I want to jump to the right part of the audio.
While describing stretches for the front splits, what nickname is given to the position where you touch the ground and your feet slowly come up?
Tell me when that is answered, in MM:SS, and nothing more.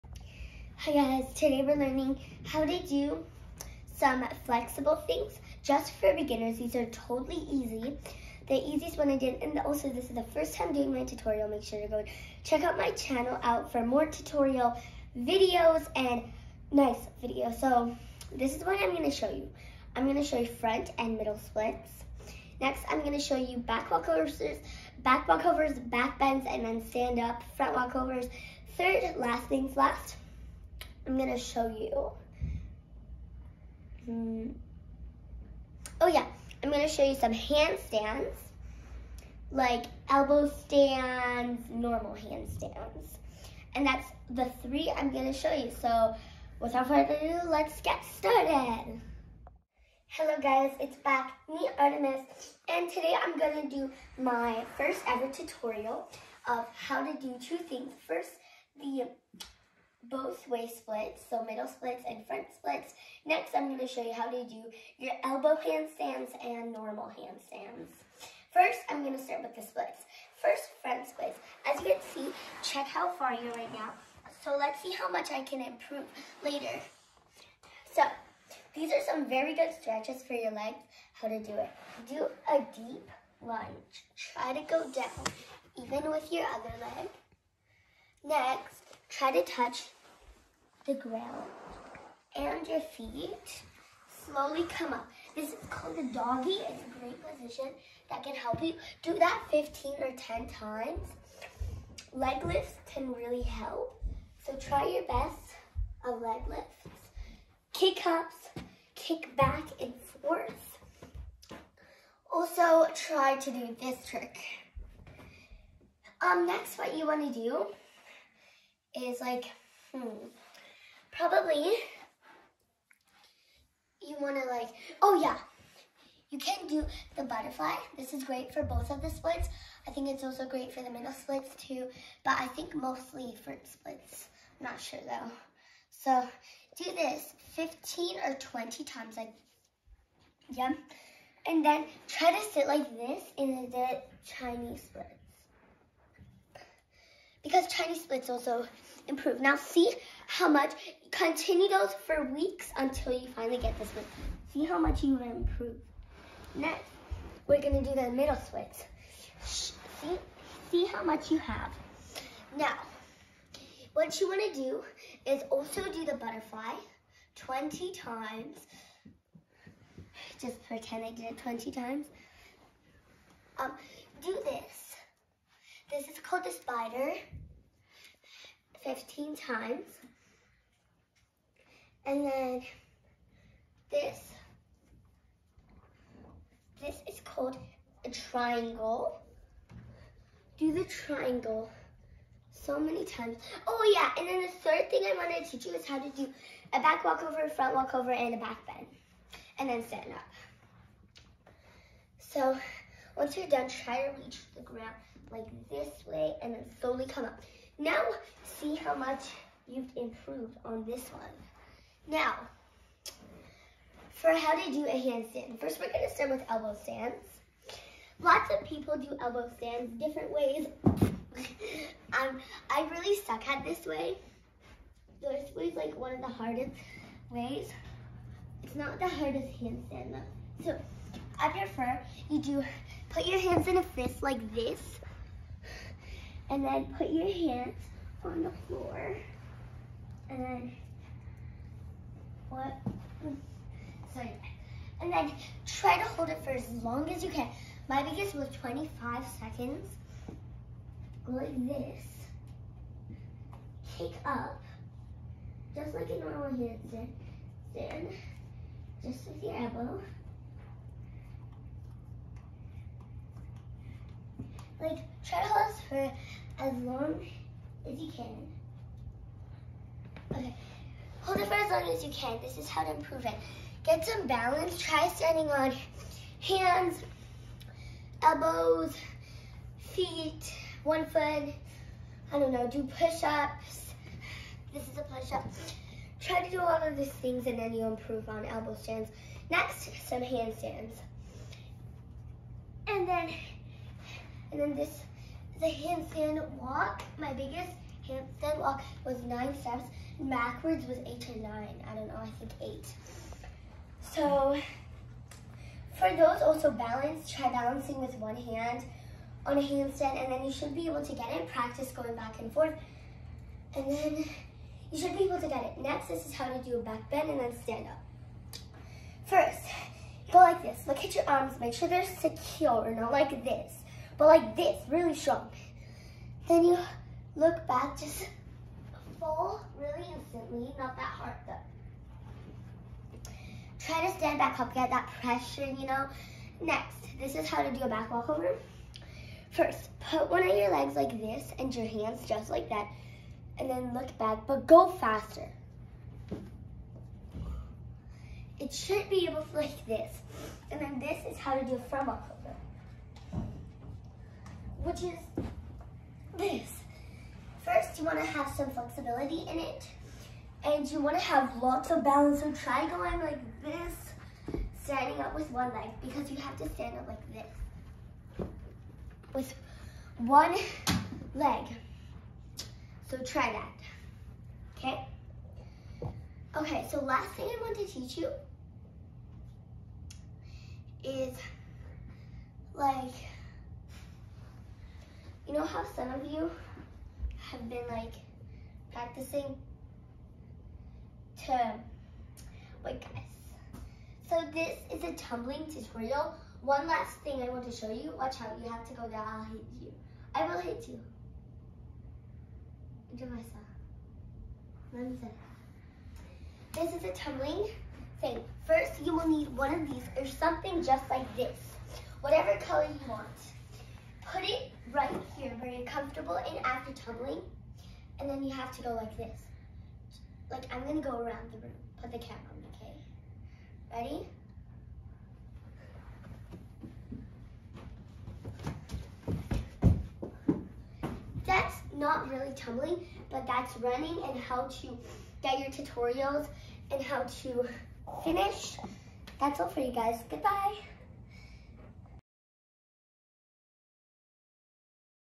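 01:35.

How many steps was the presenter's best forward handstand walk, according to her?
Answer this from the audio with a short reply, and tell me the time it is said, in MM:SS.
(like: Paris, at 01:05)
9, at 04:59.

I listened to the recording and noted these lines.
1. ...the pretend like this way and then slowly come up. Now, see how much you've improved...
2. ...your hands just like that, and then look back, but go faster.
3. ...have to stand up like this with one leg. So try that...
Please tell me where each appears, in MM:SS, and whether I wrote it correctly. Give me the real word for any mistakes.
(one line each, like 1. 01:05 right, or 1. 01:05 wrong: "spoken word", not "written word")
1. 03:24 wrong: "ground", not "pretend"
2. 05:41 right
3. 06:06 right.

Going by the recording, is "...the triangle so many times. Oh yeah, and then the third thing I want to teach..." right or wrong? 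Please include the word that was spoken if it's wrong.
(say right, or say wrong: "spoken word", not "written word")
right.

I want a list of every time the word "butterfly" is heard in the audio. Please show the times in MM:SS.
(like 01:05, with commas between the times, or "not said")
02:07, 02:46.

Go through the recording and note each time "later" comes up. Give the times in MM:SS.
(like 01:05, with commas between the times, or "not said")
01:16.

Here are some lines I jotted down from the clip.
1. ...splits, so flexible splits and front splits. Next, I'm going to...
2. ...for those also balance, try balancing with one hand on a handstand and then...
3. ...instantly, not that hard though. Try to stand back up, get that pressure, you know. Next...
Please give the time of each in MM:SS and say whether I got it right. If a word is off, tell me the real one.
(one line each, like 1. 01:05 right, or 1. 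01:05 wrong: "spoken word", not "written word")
1. 01:00 wrong: "middle", not "flexible"
2. 05:05 right
3. 05:30 right.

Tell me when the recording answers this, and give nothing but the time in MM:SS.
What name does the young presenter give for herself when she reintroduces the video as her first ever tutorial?
00:51.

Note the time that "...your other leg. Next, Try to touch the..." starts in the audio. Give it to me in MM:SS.
01:26.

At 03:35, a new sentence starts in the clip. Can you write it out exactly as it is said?
First, we're gonna start with elbow stands.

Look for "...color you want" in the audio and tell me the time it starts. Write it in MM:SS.
06:52.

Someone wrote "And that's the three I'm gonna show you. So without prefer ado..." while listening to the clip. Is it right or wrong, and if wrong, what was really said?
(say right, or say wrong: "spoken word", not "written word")
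wrong: "further", not "prefer".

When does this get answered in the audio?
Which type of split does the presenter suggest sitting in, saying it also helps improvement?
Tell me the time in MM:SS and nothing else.
02:24.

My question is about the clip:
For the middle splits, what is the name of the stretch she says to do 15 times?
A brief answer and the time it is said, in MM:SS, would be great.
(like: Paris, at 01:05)
The spider, at 02:56.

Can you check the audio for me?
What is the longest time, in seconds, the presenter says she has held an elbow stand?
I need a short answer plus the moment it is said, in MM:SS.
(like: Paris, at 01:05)
25 seconds, at 04:08.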